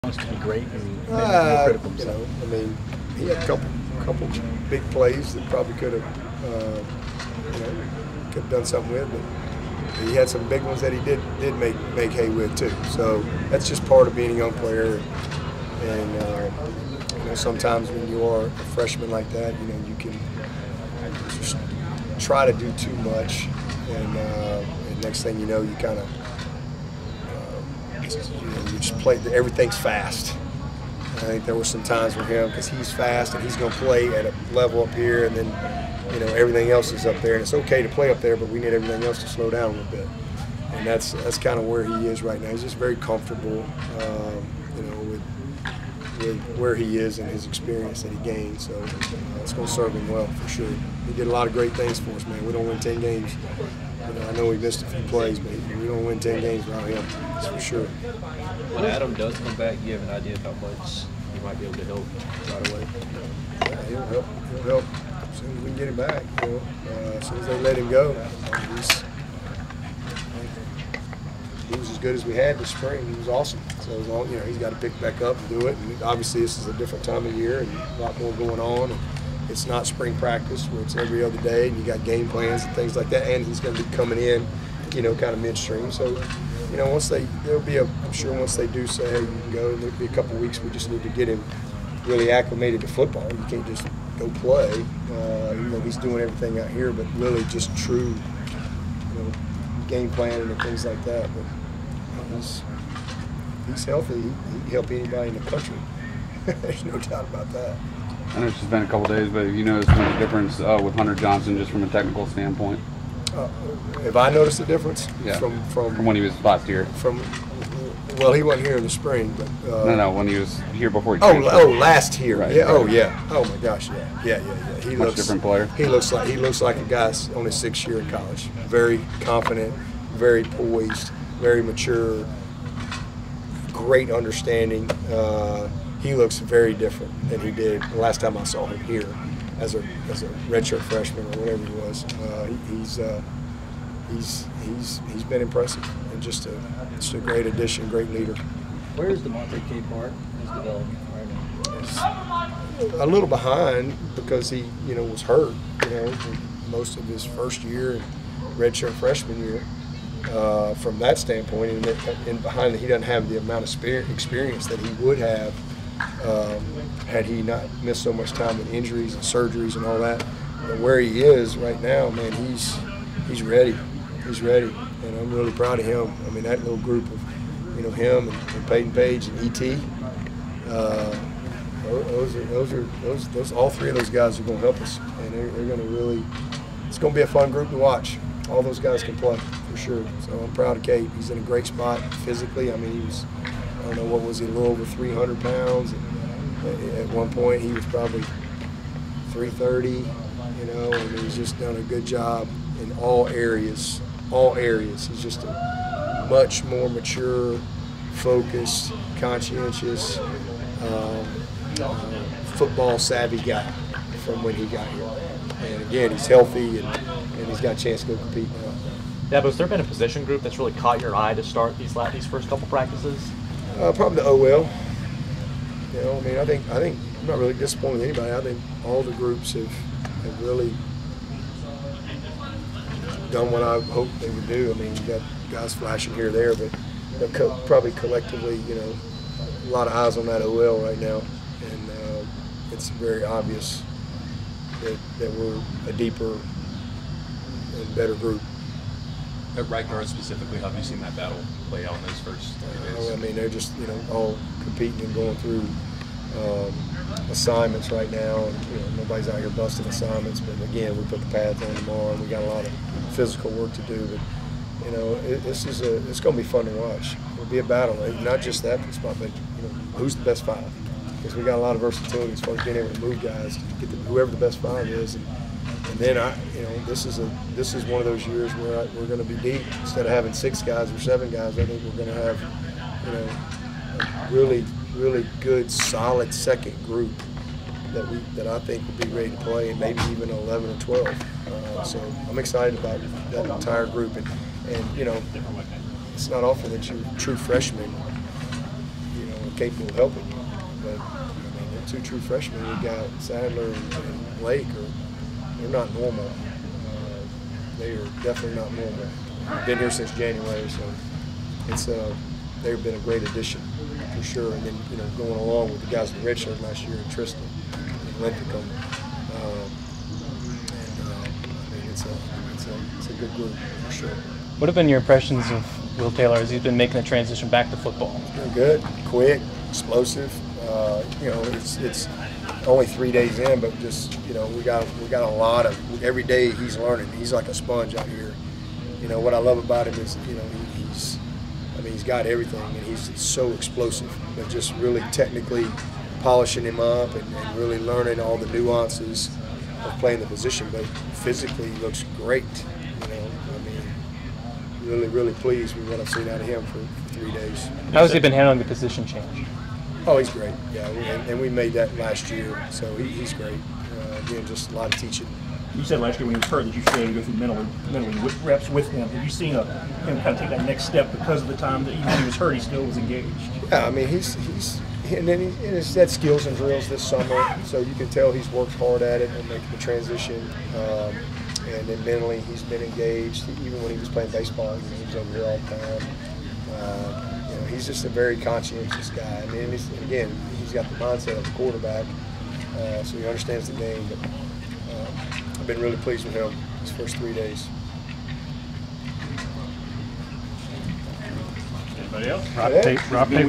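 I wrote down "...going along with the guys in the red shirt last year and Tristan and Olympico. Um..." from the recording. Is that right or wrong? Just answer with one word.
right.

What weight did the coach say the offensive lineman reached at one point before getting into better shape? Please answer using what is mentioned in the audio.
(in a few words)
330.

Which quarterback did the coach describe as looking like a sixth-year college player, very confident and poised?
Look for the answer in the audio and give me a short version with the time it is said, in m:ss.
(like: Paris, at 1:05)
Hunter Johnson, at 1:50.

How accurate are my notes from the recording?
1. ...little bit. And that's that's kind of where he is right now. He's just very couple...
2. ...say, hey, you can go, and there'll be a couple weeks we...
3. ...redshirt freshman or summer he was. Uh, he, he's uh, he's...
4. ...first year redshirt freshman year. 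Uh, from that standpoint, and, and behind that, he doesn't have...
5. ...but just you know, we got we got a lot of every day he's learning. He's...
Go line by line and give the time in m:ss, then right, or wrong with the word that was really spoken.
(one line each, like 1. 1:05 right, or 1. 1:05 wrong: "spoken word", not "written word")
1. 0:39 wrong: "comfortable", not "couple"
2. 1:28 right
3. 2:20 wrong: "whatever", not "summer"
4. 2:37 right
5. 5:33 right.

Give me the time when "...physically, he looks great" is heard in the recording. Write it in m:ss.
5:50.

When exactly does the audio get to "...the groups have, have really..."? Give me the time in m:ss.
3:49.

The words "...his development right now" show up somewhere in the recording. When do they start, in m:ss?
2:30.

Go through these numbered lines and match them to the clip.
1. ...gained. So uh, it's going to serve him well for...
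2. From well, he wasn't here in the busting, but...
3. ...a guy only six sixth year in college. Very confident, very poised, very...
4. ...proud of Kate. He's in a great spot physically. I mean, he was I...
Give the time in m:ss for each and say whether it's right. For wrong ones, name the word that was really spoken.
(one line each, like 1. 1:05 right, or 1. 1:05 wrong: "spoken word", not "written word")
1. 0:48 right
2. 1:56 wrong: "spring", not "busting"
3. 2:06 right
4. 3:10 right.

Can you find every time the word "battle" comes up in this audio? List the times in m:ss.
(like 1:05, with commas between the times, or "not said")
4:11, 4:27.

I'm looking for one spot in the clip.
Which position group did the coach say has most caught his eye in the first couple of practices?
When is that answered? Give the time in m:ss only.
3:44.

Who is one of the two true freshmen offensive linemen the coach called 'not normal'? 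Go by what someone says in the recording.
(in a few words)
Sadler.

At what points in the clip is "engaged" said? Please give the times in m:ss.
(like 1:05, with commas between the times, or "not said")
6:12, 6:22.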